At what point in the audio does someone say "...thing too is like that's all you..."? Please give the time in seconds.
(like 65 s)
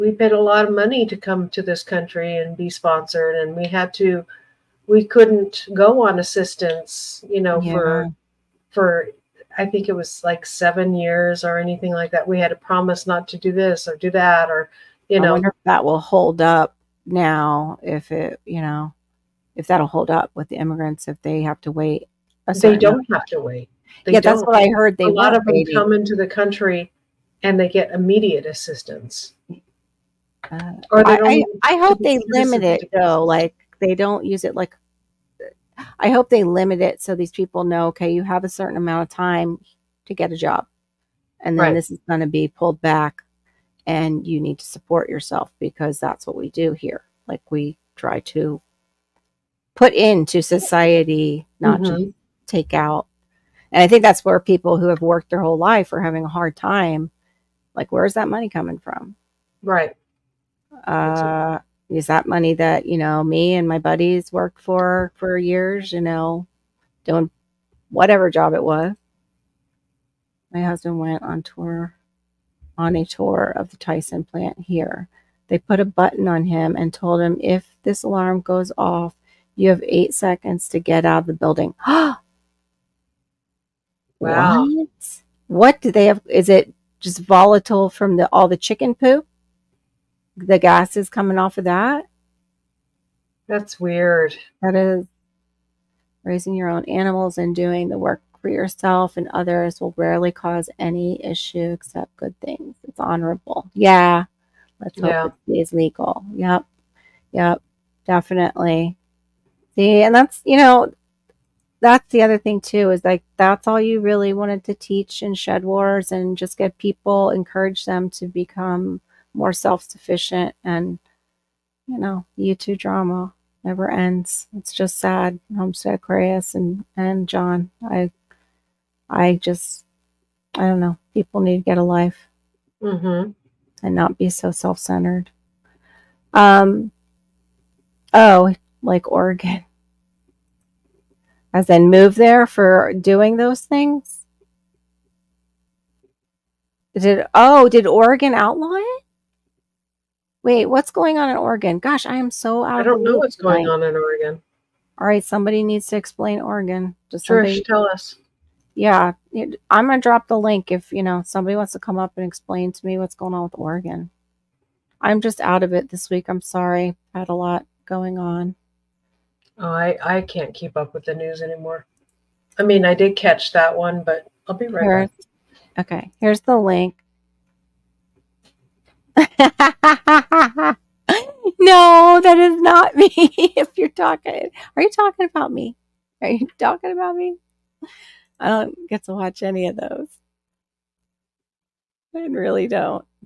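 112 s.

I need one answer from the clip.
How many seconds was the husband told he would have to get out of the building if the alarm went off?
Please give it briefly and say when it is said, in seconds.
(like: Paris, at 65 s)
8, at 79 s.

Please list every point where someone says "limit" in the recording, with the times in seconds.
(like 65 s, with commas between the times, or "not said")
32 s, 36 s.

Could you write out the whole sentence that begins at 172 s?
I mean, I did catch that one, but I'll be right Here's, back.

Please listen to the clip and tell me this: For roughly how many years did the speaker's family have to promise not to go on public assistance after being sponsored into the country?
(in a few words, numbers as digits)
7.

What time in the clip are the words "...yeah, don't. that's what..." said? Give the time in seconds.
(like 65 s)
24 s.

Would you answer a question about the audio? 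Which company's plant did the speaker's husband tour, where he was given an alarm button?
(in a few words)
Tyson.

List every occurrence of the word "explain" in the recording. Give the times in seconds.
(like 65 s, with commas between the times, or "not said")
155 s, 162 s.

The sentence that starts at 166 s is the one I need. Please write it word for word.
I'm sorry, I had a lot going on.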